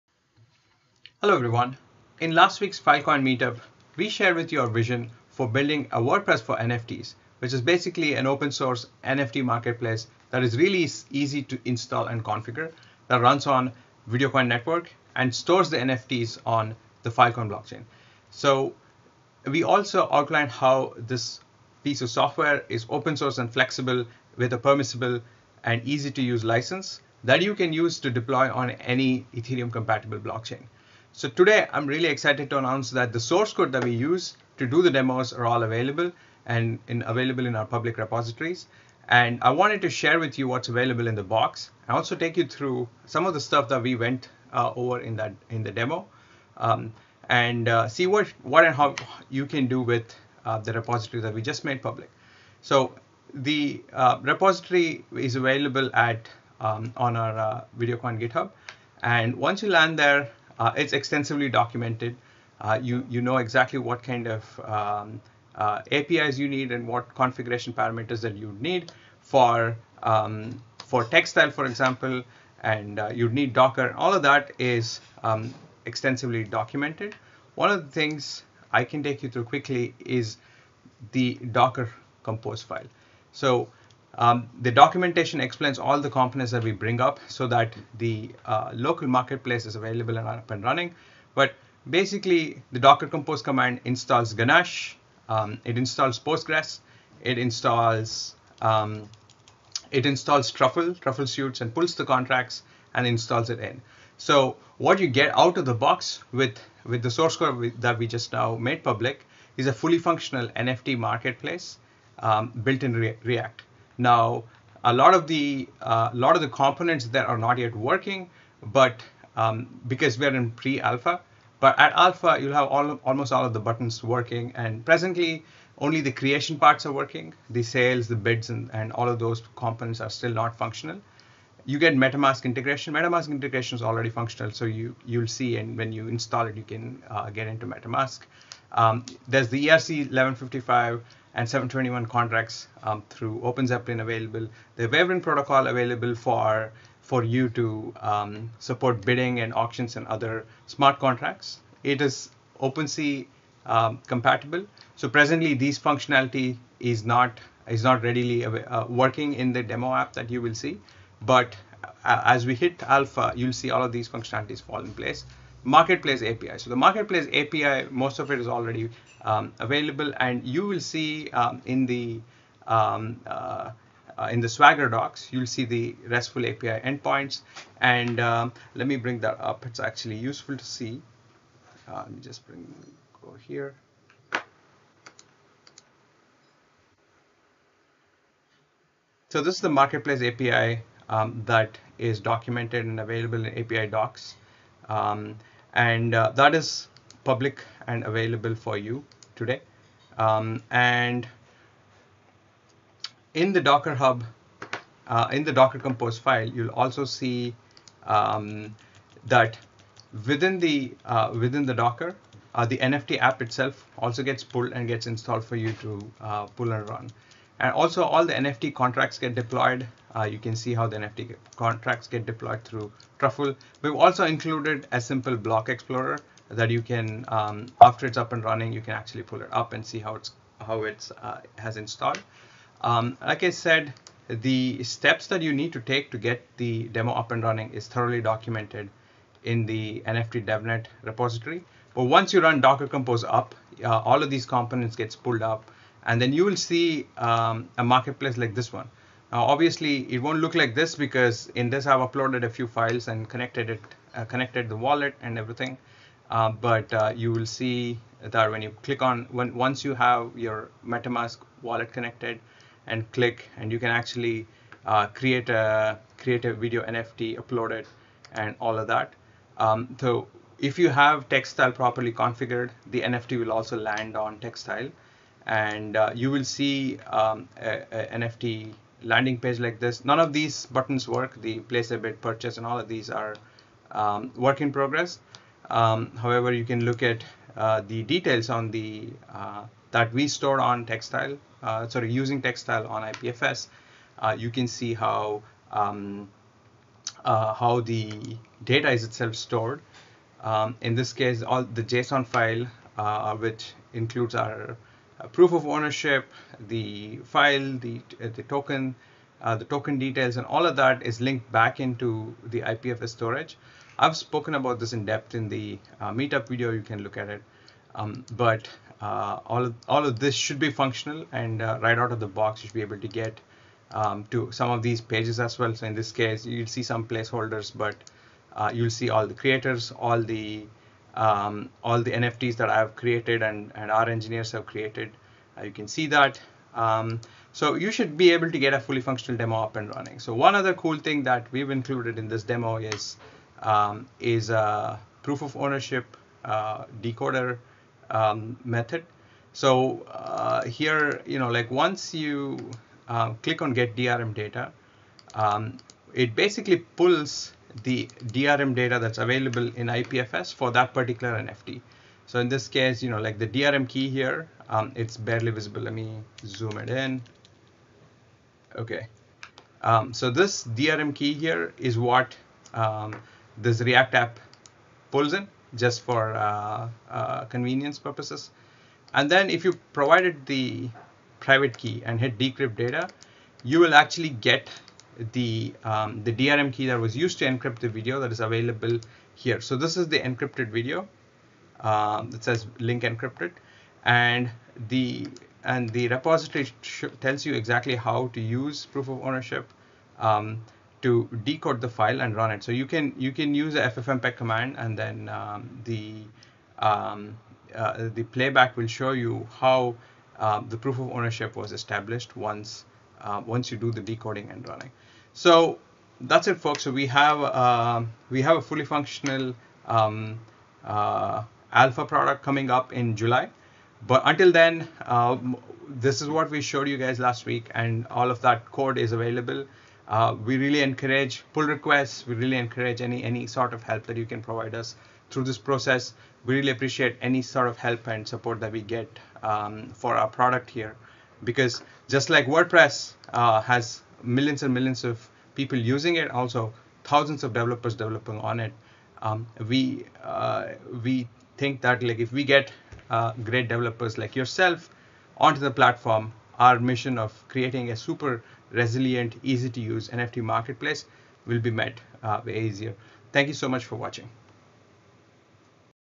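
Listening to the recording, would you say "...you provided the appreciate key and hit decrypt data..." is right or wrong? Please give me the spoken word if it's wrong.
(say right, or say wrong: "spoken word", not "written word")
wrong: "private", not "appreciate".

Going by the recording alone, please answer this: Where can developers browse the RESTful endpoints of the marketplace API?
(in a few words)
Swagger docs.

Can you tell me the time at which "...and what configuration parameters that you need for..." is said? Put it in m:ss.
1:06.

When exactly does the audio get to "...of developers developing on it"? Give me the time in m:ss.
7:27.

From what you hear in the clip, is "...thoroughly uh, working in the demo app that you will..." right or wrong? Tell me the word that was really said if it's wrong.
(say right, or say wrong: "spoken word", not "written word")
wrong: "readily", not "thoroughly".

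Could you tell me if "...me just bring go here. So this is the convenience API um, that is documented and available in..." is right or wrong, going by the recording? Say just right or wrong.
wrong.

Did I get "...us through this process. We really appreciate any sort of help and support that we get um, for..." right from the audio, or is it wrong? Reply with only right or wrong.
right.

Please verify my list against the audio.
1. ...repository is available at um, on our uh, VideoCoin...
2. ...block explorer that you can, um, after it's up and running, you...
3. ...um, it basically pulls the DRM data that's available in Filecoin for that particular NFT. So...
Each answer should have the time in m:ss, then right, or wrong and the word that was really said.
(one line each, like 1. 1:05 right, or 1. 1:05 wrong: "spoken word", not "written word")
1. 0:54 right
2. 3:45 right
3. 5:55 wrong: "IPFS", not "Filecoin".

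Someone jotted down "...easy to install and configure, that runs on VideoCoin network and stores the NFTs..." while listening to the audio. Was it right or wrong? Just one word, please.
right.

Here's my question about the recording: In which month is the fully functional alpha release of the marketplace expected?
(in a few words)
July.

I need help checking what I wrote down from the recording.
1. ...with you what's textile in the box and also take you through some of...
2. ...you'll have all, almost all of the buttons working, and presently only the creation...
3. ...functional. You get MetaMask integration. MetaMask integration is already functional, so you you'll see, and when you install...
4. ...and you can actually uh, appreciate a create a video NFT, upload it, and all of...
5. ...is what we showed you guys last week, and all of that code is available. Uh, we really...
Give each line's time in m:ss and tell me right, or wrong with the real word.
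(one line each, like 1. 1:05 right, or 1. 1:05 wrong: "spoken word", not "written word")
1. 0:40 wrong: "available", not "textile"
2. 2:02 right
3. 2:10 right
4. 4:23 wrong: "create", not "appreciate"
5. 7:06 right.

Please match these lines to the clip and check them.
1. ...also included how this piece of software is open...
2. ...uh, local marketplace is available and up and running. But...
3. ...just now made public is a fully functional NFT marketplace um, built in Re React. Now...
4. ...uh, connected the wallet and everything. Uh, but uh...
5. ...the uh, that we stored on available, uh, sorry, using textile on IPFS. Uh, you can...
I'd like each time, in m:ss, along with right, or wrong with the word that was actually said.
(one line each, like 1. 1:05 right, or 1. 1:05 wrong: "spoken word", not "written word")
1. 0:19 wrong: "outlined", not "included"
2. 1:28 right
3. 1:48 right
4. 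4:14 right
5. 4:48 wrong: "textile", not "available".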